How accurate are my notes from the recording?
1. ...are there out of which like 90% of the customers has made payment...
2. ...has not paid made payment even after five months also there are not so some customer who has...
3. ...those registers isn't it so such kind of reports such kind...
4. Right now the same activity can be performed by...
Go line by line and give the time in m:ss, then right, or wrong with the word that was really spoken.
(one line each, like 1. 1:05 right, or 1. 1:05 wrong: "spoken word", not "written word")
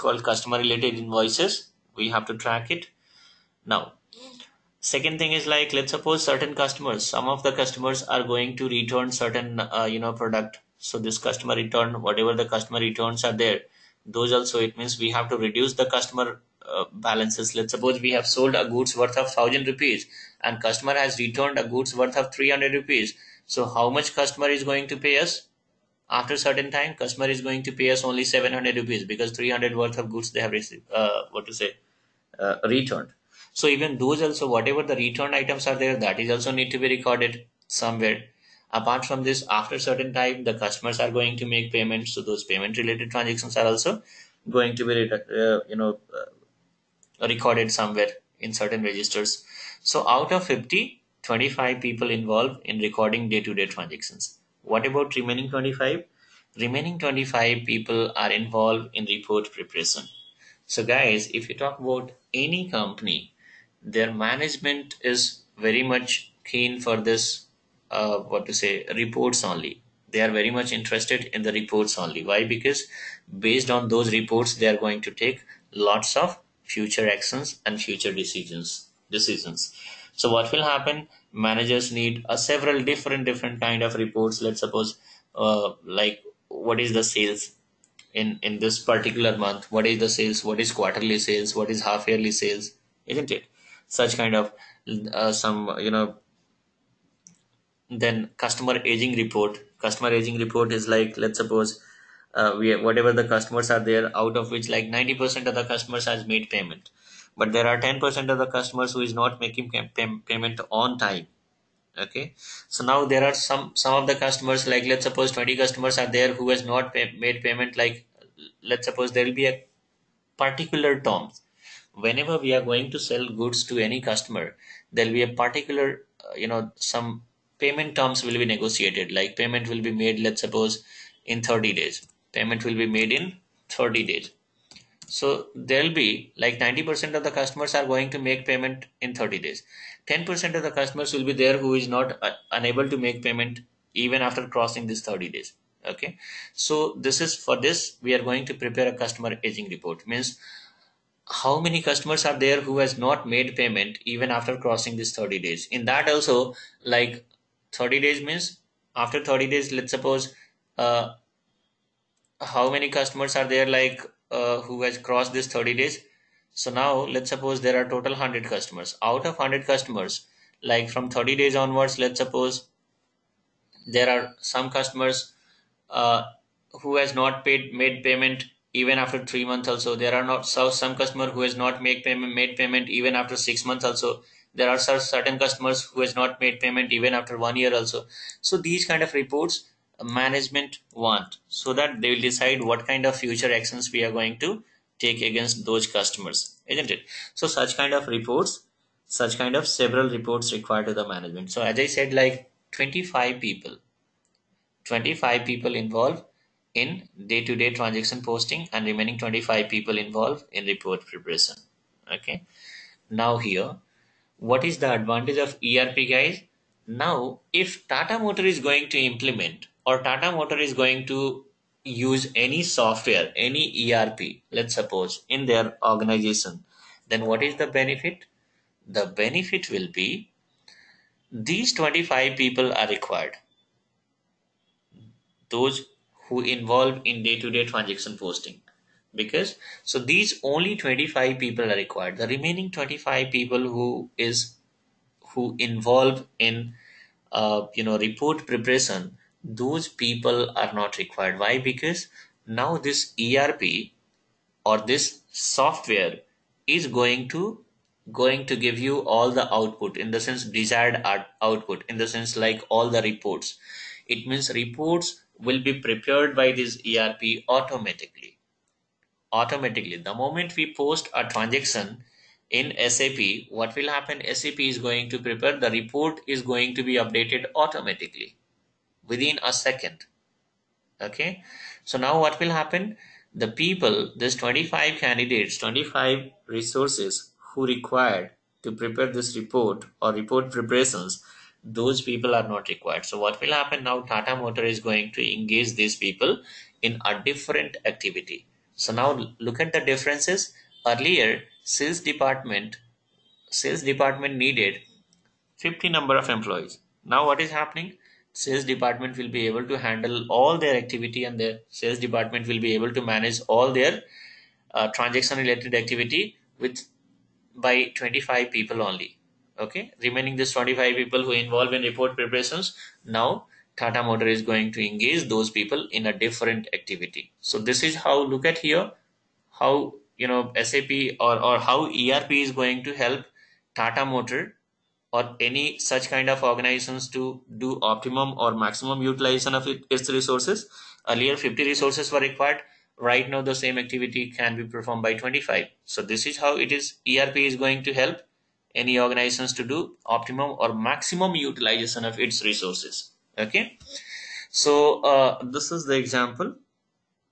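1. 1:43 right
2. 2:56 wrong: "three", not "five"
3. 3:15 wrong: "customers", not "registers"
4. 5:42 right.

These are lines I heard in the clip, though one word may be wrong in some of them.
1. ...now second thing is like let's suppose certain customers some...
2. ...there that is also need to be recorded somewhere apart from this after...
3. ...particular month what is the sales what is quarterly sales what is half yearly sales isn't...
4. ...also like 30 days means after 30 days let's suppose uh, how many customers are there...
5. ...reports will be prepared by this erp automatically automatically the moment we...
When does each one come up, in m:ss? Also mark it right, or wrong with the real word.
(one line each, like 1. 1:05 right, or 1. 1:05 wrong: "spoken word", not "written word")
1. 0:03 right
2. 0:35 right
3. 1:28 right
4. 2:36 right
5. 4:24 right.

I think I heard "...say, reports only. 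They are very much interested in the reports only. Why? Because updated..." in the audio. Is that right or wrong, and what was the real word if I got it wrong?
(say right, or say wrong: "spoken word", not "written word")
wrong: "based", not "updated".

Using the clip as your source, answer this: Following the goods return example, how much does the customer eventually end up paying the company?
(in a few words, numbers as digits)
700 rupees.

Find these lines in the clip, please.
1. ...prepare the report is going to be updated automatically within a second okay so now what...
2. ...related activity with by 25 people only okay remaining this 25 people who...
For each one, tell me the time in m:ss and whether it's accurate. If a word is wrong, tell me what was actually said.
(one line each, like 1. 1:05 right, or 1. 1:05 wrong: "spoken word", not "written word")
1. 4:35 right
2. 5:15 right.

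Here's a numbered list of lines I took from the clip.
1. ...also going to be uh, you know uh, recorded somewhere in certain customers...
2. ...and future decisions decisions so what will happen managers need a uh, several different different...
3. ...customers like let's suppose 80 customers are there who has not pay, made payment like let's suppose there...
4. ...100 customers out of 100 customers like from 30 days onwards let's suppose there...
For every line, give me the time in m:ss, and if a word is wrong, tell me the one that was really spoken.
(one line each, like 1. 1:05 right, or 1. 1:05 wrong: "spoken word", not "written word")
1. 0:43 wrong: "registers", not "customers"
2. 1:17 right
3. 1:54 wrong: "20", not "80"
4. 2:48 right.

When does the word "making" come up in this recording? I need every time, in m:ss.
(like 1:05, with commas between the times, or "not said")
1:49.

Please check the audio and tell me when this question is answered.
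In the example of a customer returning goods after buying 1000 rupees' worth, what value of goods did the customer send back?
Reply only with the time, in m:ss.
0:22.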